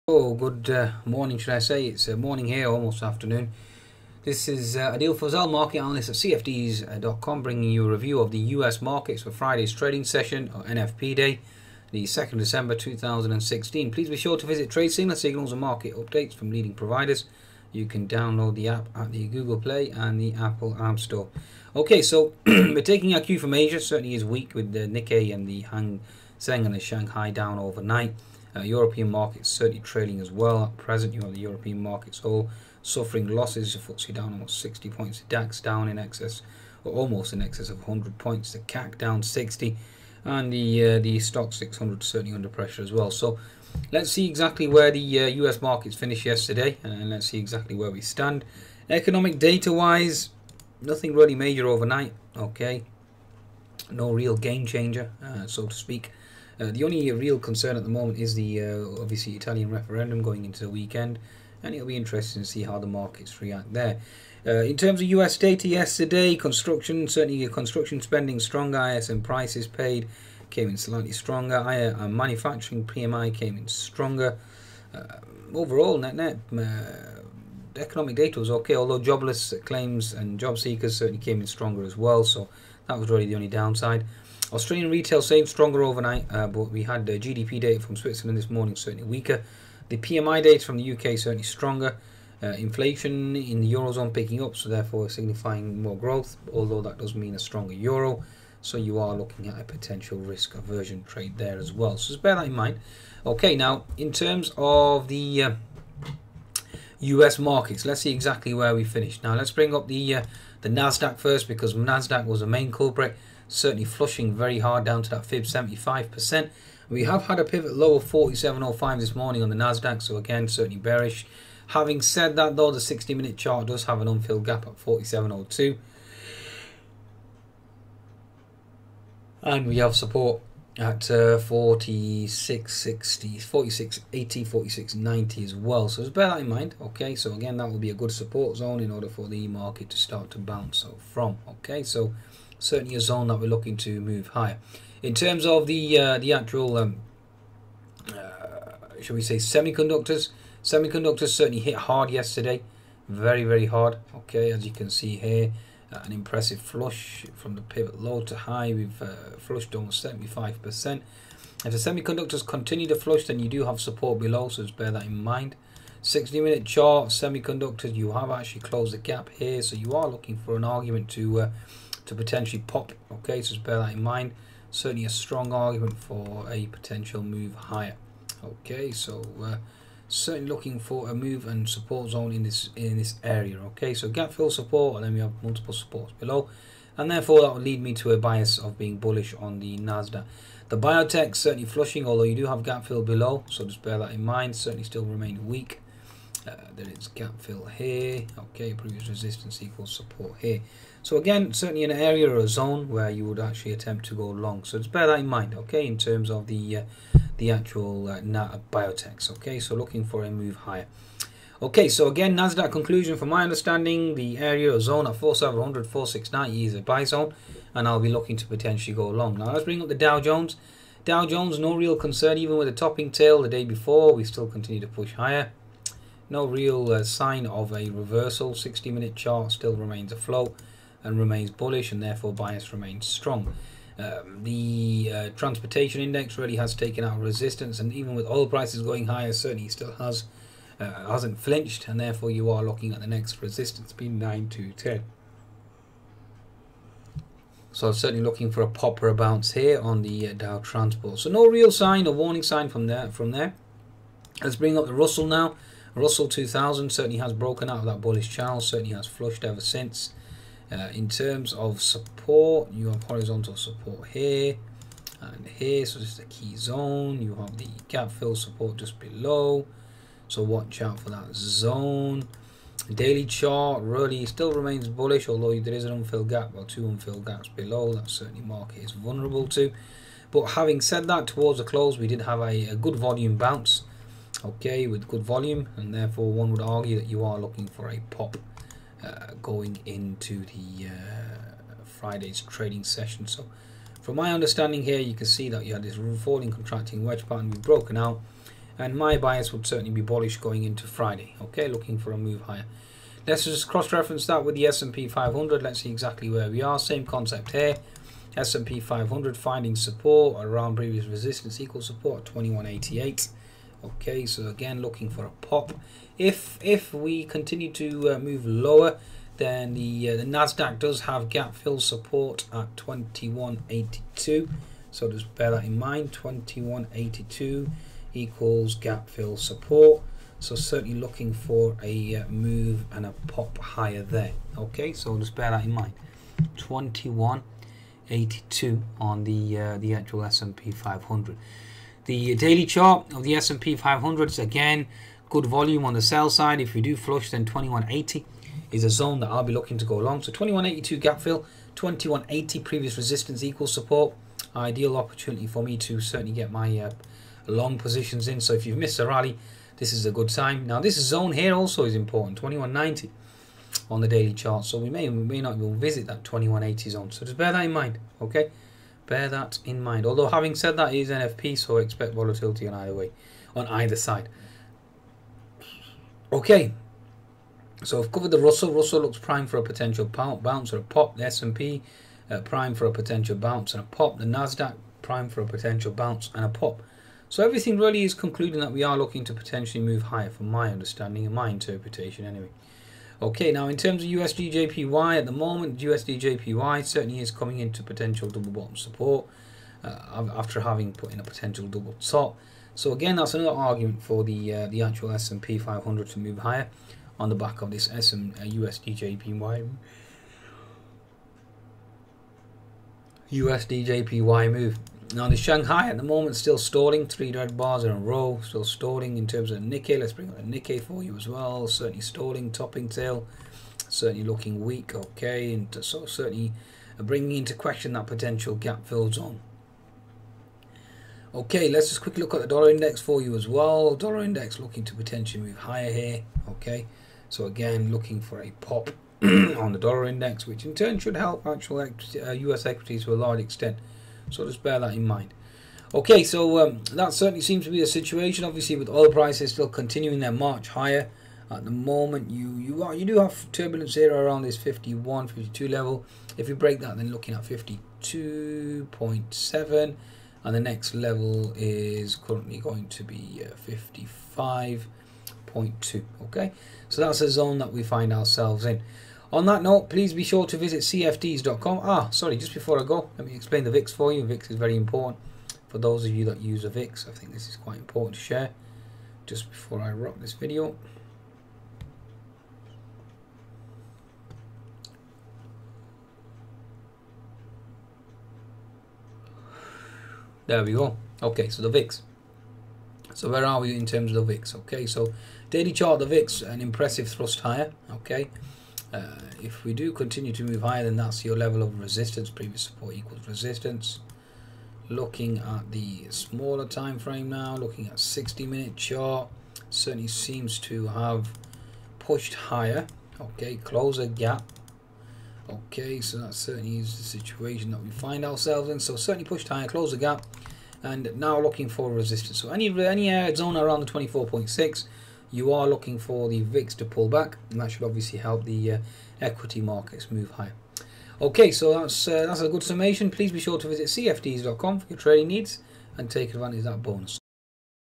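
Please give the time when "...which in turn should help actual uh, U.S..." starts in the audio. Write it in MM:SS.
07:20.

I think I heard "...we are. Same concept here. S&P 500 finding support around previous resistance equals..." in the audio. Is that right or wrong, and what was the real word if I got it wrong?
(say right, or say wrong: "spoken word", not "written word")
right.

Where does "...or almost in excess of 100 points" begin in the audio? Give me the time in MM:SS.
00:36.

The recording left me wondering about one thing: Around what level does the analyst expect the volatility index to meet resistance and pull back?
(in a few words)
24.6.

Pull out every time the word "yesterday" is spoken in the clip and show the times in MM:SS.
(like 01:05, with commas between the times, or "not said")
00:46, 01:05, 02:32.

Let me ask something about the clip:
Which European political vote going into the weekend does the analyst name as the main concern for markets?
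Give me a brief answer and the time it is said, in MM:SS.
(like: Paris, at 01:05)
Italian referendum, at 00:59.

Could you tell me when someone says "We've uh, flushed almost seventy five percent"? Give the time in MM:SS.
02:38.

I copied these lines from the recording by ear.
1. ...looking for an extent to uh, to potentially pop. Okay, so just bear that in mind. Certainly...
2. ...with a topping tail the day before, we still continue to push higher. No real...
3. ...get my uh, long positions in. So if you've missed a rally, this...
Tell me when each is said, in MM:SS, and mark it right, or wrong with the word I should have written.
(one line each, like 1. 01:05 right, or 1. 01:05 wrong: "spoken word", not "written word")
1. 02:50 wrong: "argument", not "extent"
2. 03:42 right
3. 05:56 right.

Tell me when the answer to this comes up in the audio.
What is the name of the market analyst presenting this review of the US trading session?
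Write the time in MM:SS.
00:04.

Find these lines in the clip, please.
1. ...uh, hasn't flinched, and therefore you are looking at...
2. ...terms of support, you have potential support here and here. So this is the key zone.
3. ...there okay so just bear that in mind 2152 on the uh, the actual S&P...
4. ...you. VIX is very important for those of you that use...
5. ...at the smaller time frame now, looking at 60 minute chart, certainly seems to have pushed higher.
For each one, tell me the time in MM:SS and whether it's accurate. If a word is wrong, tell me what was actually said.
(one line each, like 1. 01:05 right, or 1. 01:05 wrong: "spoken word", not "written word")
1. 04:00 right
2. 04:21 wrong: "horizontal", not "potential"
3. 05:34 wrong: "2182", not "2152"
4. 07:54 right
5. 08:25 right.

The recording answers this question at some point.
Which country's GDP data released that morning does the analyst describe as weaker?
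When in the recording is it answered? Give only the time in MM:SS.
01:27.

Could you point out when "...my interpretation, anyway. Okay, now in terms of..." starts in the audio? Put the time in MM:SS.
06:31.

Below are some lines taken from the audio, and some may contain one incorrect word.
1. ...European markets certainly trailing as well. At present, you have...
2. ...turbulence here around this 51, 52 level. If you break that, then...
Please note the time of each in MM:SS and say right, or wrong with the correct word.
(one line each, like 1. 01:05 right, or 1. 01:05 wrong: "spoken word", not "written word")
1. 00:28 right
2. 07:33 right.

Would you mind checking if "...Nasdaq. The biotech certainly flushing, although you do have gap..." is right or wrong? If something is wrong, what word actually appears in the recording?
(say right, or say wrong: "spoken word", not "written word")
right.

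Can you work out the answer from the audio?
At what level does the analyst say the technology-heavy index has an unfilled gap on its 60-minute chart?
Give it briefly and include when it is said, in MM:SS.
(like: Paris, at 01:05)
47.02, at 02:04.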